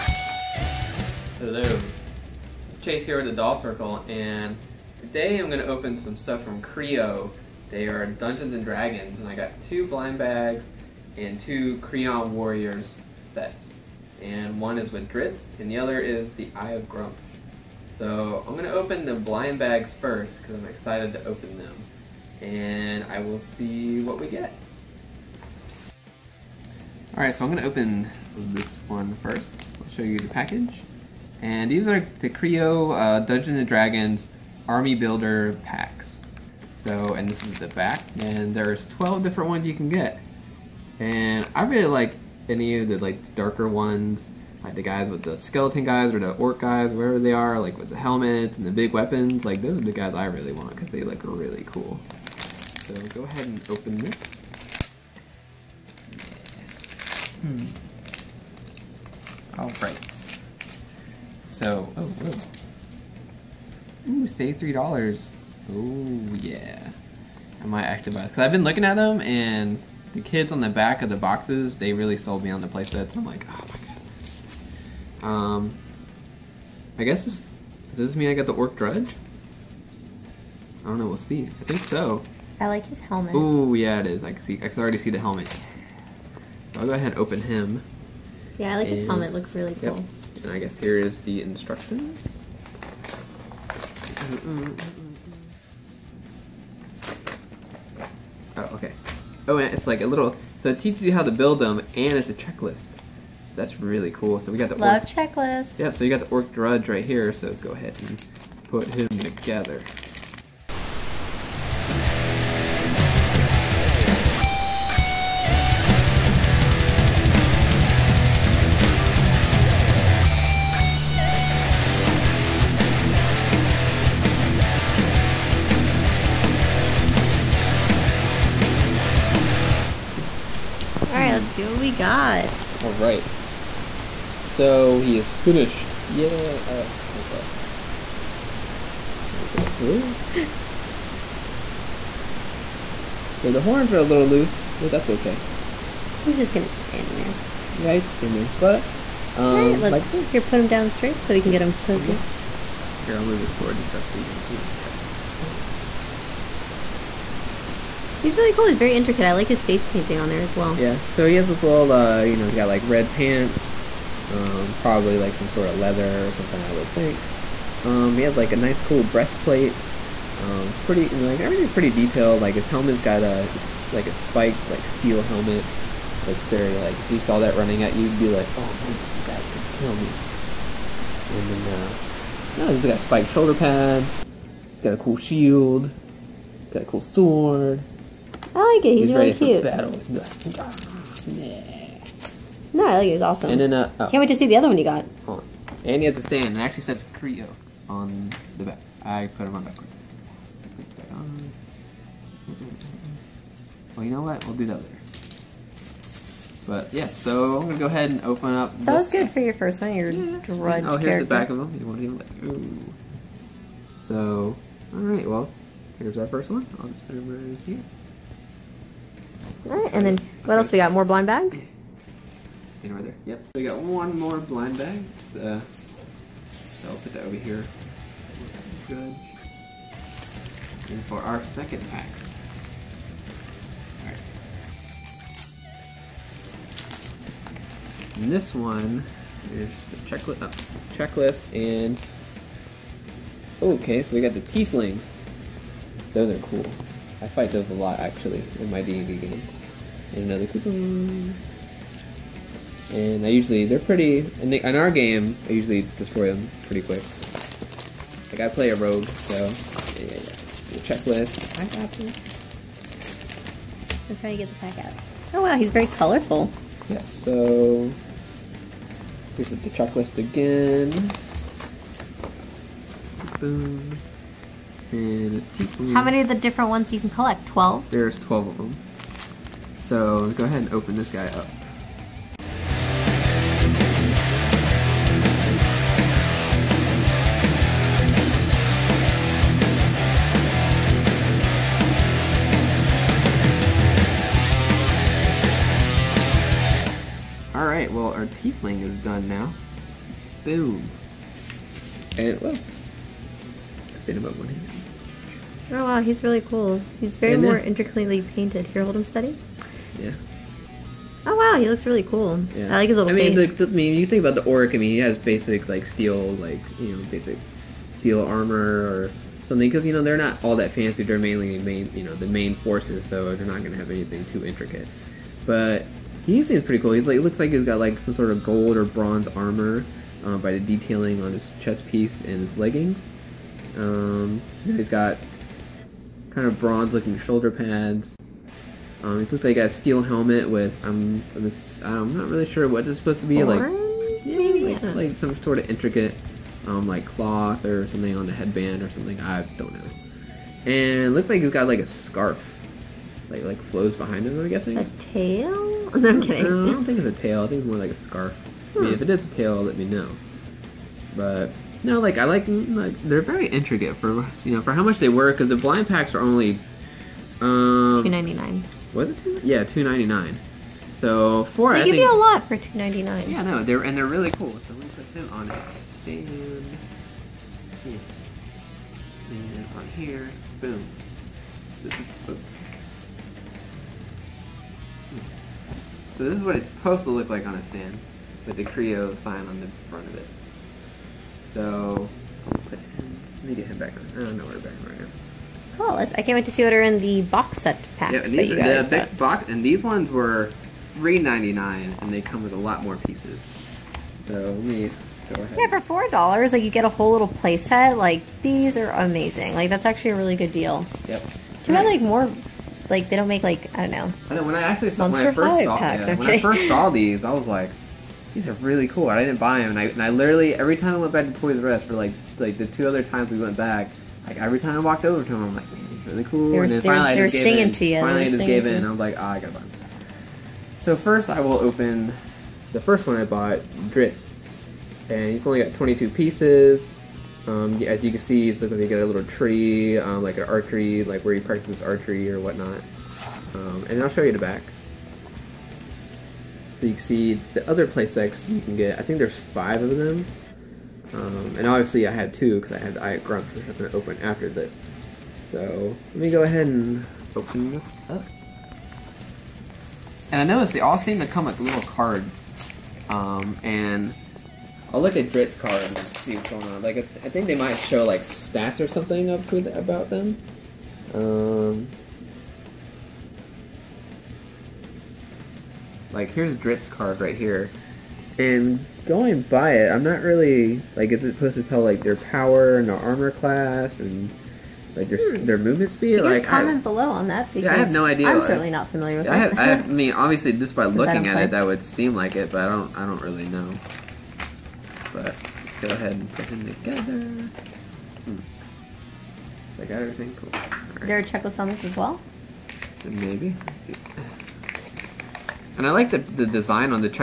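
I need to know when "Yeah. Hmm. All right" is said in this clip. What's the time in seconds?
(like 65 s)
57 s.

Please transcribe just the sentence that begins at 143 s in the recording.
so the horns are a little loose, but that's okay.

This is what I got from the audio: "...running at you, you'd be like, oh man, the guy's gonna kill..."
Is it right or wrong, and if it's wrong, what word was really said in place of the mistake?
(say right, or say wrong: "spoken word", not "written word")
right.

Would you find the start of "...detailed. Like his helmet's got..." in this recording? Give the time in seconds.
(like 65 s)
171 s.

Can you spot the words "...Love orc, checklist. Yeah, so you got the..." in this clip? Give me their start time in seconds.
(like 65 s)
104 s.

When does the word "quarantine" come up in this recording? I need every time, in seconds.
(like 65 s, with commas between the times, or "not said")
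not said.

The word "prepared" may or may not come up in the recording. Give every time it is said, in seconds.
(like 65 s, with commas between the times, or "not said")
not said.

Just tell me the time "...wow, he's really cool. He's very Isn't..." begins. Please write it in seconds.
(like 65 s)
305 s.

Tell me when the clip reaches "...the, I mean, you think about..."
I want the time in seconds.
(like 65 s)
313 s.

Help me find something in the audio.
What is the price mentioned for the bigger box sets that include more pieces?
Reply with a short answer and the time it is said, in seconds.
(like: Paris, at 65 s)
3.99, at 400 s.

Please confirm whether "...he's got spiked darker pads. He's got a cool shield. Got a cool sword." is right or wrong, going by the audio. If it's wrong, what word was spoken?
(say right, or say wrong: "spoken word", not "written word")
wrong: "shoulder", not "darker".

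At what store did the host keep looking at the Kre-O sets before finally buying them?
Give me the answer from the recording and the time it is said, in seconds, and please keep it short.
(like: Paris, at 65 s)
Toys R Us, at 421 s.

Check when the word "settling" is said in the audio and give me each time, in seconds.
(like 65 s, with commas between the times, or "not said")
not said.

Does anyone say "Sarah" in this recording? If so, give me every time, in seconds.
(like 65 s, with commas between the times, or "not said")
not said.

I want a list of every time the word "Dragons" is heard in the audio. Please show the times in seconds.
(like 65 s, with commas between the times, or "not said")
8 s, 33 s.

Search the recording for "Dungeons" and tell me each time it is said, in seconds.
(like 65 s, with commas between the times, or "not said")
8 s, 33 s.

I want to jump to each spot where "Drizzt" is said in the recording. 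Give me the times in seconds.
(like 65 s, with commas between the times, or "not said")
15 s, 433 s, 465 s, 476 s.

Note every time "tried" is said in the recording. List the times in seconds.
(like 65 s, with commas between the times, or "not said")
not said.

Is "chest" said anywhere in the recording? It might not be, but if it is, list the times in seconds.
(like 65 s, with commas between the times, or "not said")
154 s, 331 s.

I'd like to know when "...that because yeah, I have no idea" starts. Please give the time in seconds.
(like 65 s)
487 s.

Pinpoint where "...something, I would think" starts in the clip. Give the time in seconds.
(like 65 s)
166 s.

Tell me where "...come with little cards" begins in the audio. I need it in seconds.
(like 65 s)
461 s.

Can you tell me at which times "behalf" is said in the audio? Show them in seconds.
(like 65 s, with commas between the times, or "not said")
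not said.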